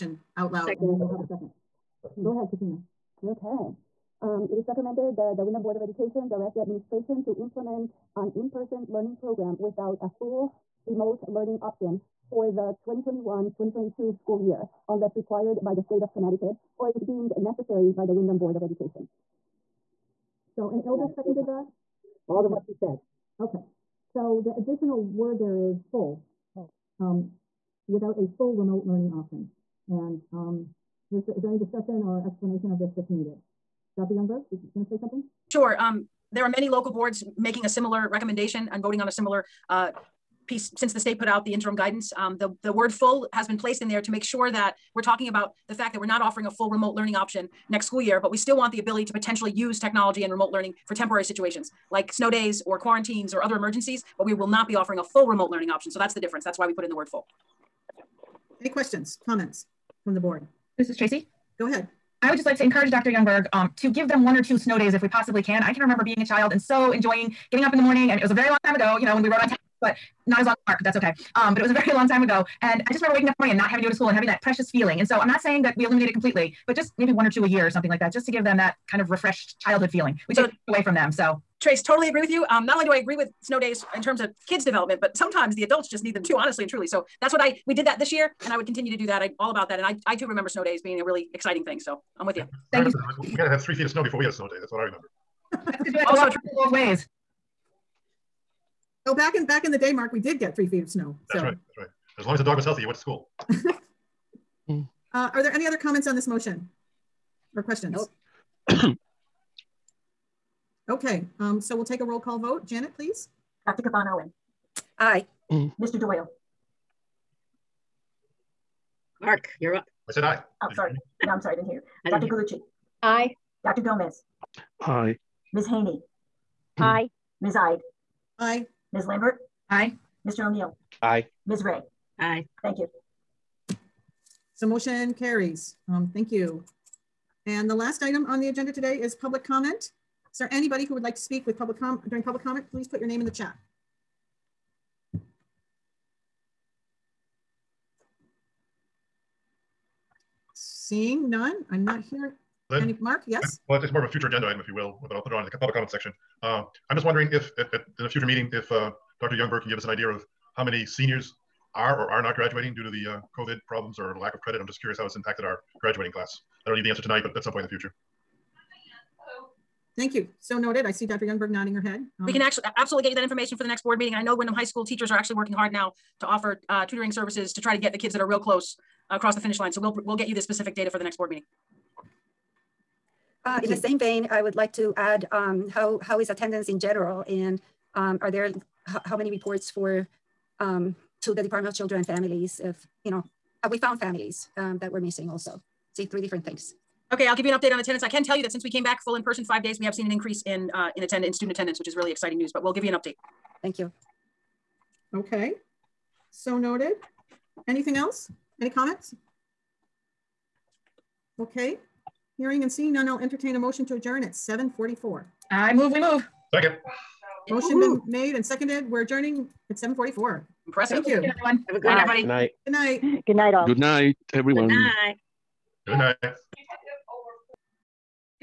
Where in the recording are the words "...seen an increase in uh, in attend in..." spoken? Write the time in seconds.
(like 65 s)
199 s.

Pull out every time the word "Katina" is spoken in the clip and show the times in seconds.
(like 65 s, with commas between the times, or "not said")
2 s.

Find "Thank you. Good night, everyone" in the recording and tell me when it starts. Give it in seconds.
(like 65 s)
220 s.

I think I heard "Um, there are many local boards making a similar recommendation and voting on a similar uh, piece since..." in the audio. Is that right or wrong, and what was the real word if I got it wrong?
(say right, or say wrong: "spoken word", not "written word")
right.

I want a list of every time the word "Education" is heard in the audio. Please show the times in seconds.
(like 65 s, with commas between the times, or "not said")
5 s, 18 s.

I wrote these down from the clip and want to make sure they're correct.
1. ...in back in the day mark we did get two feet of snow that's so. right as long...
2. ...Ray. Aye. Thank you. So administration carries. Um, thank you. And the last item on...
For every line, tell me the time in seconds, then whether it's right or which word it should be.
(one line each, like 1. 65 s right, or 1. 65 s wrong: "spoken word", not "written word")
1. 99 s wrong: "three", not "two"
2. 131 s wrong: "motion", not "administration".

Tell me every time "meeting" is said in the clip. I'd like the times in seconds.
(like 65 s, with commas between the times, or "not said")
158 s, 173 s, 181 s.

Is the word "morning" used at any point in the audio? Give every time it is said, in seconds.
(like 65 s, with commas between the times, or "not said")
67 s, 73 s.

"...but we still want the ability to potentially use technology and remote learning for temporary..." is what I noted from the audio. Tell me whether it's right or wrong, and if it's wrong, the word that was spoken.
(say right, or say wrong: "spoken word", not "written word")
right.